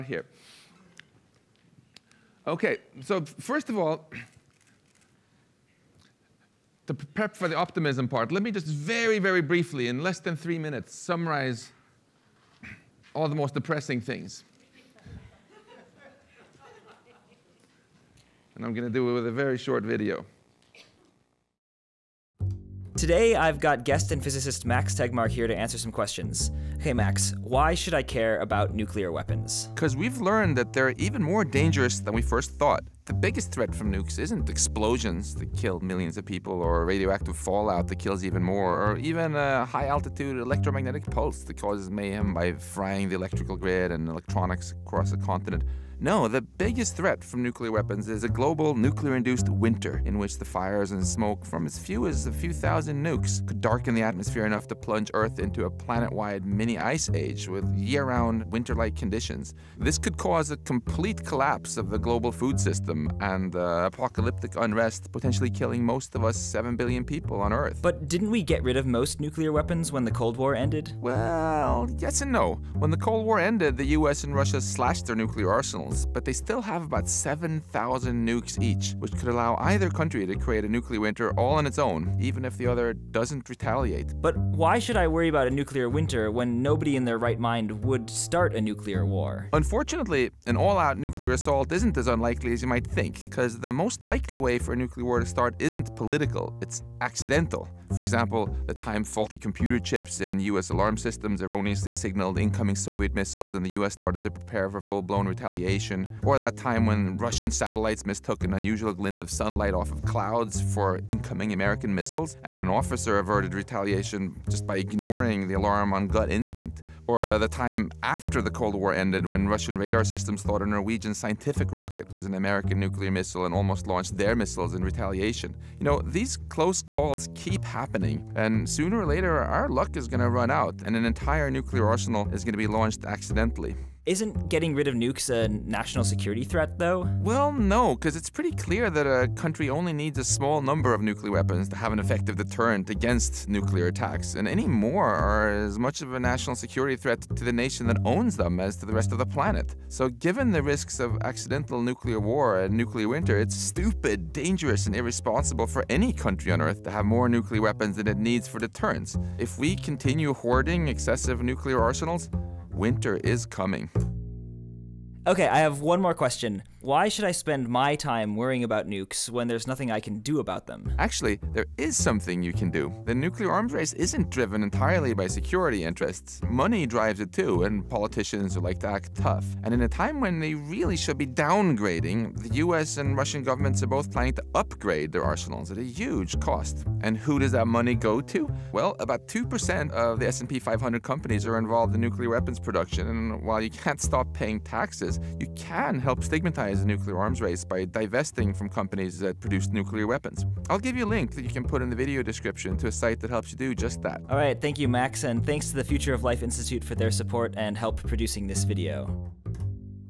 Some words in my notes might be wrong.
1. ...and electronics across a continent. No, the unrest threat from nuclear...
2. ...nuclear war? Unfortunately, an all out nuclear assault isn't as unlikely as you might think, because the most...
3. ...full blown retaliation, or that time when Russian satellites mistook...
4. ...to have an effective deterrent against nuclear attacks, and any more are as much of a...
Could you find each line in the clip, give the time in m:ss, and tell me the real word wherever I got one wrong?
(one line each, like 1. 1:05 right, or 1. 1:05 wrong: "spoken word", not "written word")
1. 0:43 wrong: "biggest", not "unrest"
2. 1:28 right
3. 1:44 right
4. 2:21 right.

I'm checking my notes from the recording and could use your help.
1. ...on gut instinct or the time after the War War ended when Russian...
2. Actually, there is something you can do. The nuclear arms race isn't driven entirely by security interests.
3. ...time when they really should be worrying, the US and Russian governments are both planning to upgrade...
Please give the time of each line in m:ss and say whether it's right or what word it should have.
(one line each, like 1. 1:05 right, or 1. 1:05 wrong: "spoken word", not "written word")
1. 1:55 wrong: "Cold", not "War"
2. 2:50 right
3. 2:59 wrong: "downgrading", not "worrying".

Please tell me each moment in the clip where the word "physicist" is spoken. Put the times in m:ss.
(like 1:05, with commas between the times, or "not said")
0:24.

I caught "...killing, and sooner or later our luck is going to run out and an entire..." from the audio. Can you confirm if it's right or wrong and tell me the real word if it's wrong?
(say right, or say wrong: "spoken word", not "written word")
wrong: "happening", not "killing".